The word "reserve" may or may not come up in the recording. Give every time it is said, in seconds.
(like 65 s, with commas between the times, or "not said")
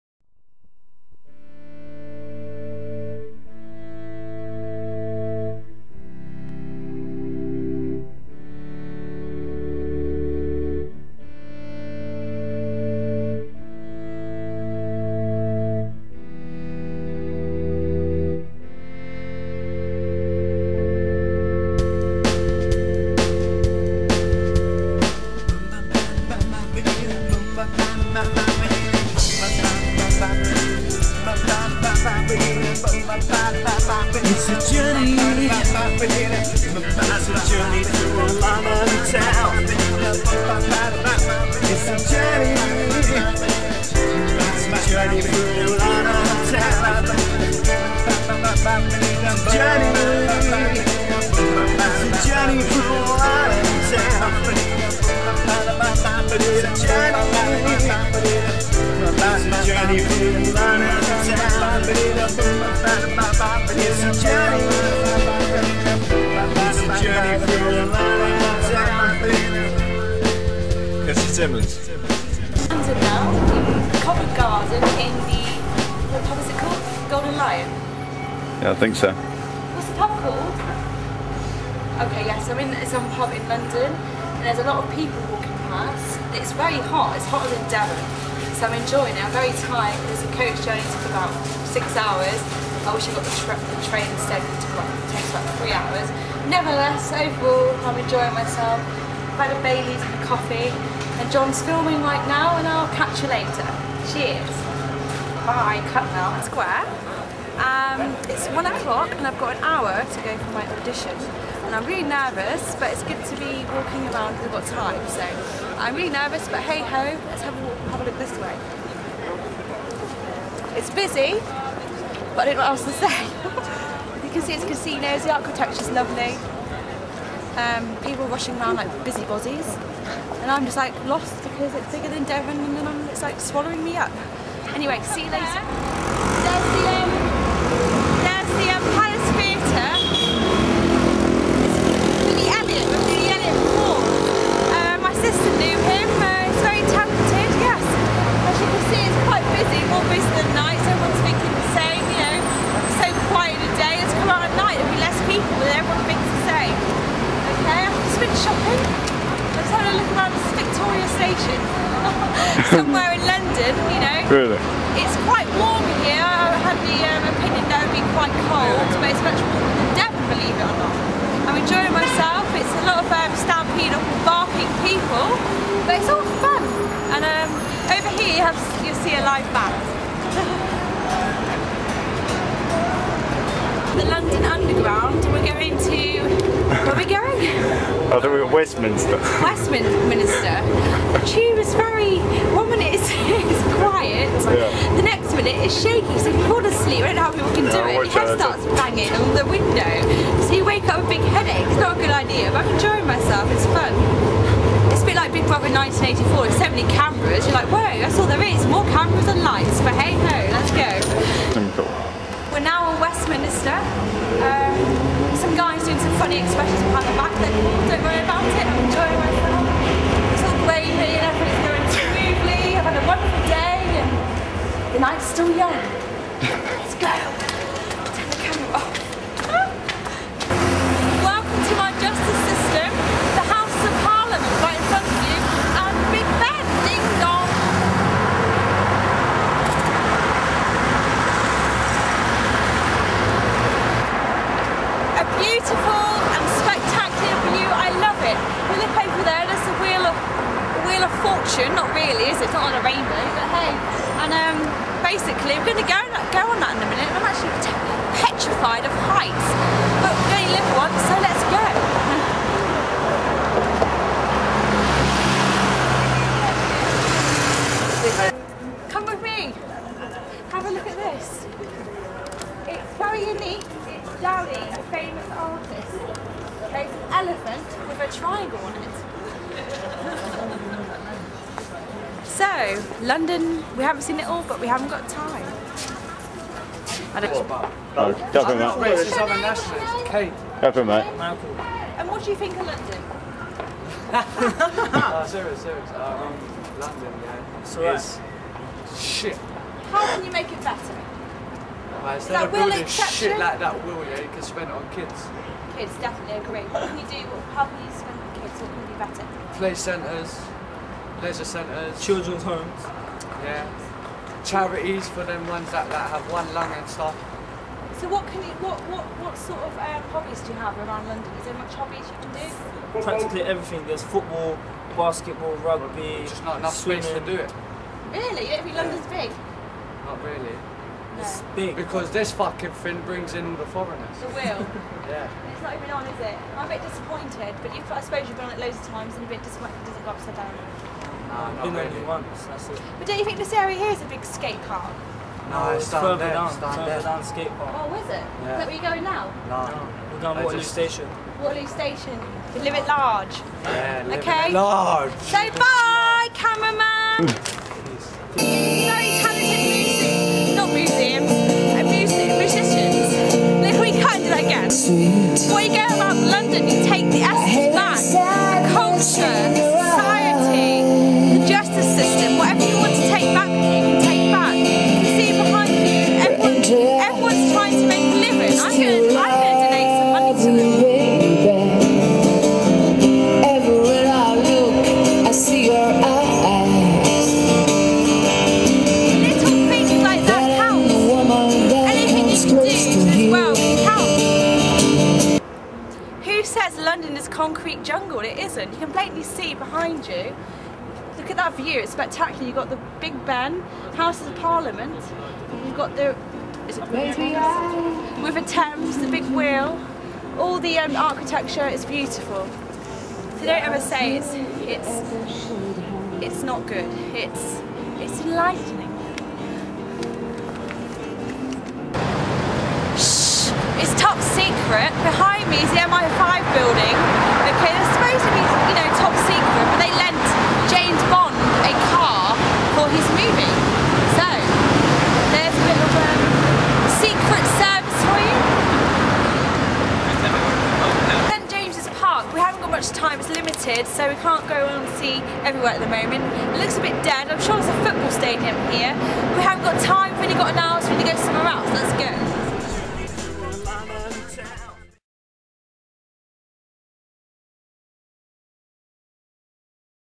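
not said.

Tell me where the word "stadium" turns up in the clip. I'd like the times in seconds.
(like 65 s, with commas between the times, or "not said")
448 s.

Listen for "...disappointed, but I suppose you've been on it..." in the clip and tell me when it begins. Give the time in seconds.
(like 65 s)
336 s.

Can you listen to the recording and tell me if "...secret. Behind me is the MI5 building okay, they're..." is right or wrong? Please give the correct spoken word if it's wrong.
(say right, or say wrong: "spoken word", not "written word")
right.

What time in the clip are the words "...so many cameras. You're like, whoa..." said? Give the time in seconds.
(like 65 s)
206 s.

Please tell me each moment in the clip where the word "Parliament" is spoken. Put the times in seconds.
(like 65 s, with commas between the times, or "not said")
234 s, 404 s.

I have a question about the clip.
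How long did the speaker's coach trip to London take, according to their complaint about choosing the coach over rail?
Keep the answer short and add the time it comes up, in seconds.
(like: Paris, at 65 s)
6 hours, at 91 s.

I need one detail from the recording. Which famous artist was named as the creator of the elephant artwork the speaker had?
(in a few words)
Dali.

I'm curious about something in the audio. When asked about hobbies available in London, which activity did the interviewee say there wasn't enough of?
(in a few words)
Swimming.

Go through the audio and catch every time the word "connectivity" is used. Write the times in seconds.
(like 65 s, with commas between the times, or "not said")
not said.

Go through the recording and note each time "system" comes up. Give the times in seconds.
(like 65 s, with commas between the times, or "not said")
232 s.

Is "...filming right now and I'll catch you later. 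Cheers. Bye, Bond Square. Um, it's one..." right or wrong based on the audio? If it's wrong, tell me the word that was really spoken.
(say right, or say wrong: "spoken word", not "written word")
wrong: "Cutnell", not "Bond".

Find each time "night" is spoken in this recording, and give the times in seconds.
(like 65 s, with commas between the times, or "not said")
225 s.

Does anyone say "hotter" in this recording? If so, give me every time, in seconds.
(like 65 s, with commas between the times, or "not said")
87 s.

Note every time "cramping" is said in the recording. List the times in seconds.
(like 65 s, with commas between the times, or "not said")
not said.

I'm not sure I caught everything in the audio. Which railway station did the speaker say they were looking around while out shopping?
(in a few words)
Victoria Station.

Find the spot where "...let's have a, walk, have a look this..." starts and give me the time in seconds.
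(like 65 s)
117 s.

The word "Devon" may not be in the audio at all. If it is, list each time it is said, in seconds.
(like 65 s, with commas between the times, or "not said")
87 s, 132 s, 169 s.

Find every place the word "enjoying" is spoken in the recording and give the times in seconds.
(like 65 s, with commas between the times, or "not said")
88 s, 97 s, 171 s, 202 s, 218 s.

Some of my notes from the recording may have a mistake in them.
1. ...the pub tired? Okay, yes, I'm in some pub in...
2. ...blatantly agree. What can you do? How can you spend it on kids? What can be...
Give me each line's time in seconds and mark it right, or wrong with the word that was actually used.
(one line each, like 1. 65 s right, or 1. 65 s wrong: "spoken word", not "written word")
1. 79 s wrong: "called", not "tired"
2. 305 s wrong: "definitely", not "blatantly".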